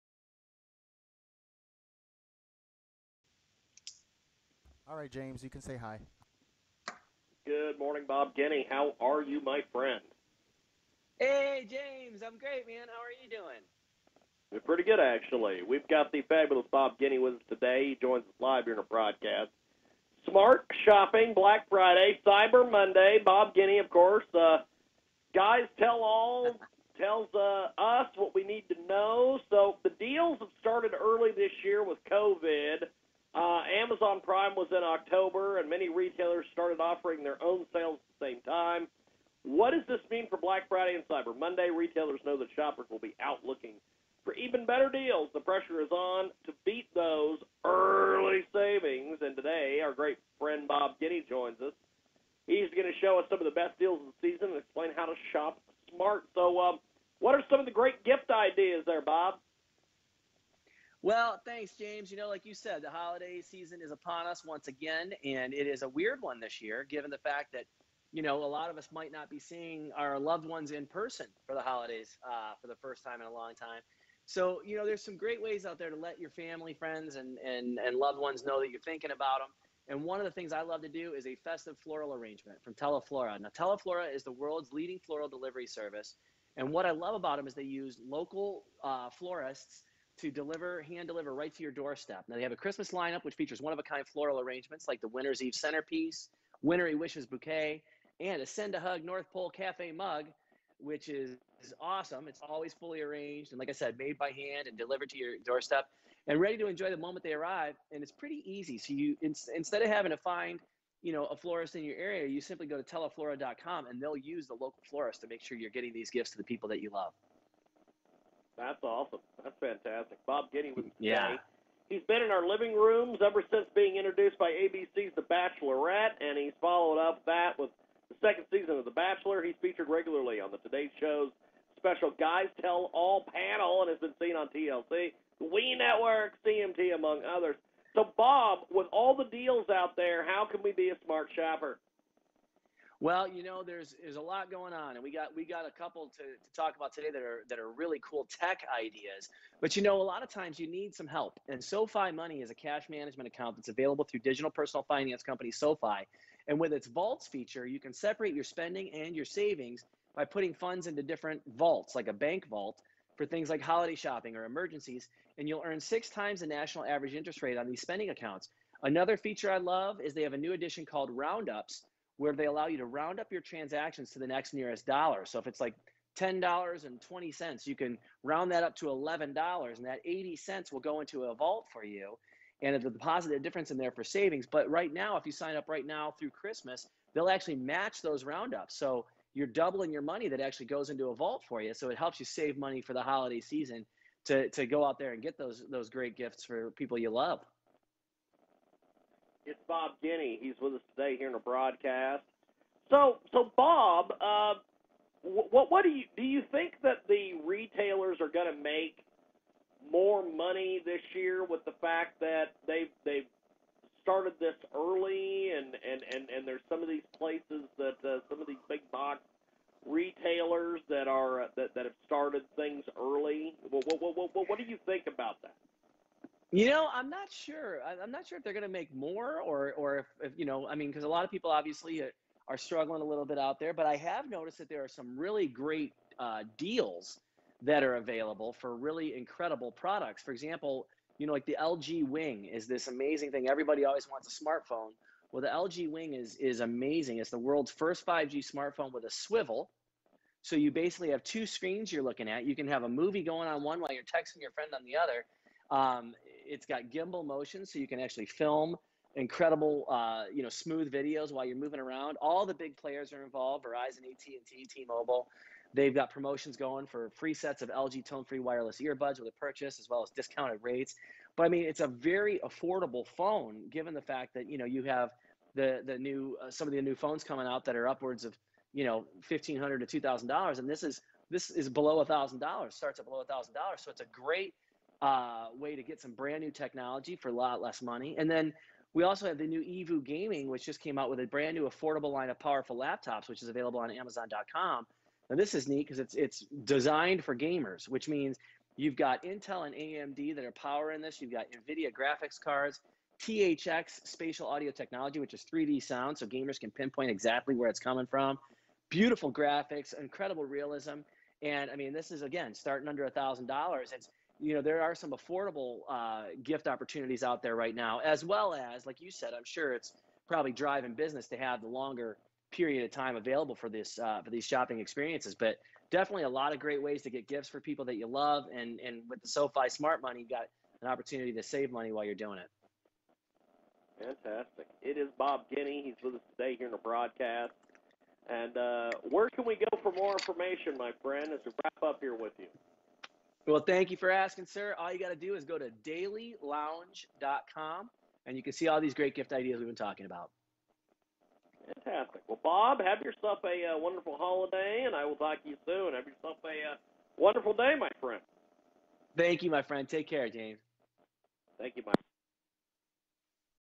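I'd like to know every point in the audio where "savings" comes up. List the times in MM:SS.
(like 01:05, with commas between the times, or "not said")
00:48, 02:39, 03:04.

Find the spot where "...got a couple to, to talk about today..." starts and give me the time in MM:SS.
02:25.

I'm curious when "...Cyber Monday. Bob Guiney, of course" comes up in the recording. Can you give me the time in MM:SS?
00:22.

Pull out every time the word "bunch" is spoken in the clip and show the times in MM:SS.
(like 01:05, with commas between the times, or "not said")
not said.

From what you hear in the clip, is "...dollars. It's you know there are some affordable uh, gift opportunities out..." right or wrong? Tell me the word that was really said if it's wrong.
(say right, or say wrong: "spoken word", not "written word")
right.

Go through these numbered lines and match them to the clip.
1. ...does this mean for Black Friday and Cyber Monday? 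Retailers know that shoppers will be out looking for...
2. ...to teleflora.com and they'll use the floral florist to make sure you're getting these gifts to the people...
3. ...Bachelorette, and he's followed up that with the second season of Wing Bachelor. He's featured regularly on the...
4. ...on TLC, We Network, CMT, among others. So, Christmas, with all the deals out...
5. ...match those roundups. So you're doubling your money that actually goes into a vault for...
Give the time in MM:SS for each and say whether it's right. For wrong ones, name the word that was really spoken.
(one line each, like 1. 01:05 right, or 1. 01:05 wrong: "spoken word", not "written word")
1. 00:39 right
2. 01:52 wrong: "local", not "floral"
3. 02:05 wrong: "The", not "Wing"
4. 02:14 wrong: "Bob", not "Christmas"
5. 03:07 right.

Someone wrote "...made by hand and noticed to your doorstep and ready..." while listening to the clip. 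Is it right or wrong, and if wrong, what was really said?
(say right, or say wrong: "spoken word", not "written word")
wrong: "delivered", not "noticed".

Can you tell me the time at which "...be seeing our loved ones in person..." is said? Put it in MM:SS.
01:09.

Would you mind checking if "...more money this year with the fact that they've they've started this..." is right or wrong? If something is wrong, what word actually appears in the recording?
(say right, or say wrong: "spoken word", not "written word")
right.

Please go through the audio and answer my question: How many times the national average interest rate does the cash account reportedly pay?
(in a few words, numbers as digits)
6.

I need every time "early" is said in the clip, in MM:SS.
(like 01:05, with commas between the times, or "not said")
00:30, 00:47, 03:34, 03:42.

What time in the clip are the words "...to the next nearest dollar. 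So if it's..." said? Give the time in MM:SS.
02:54.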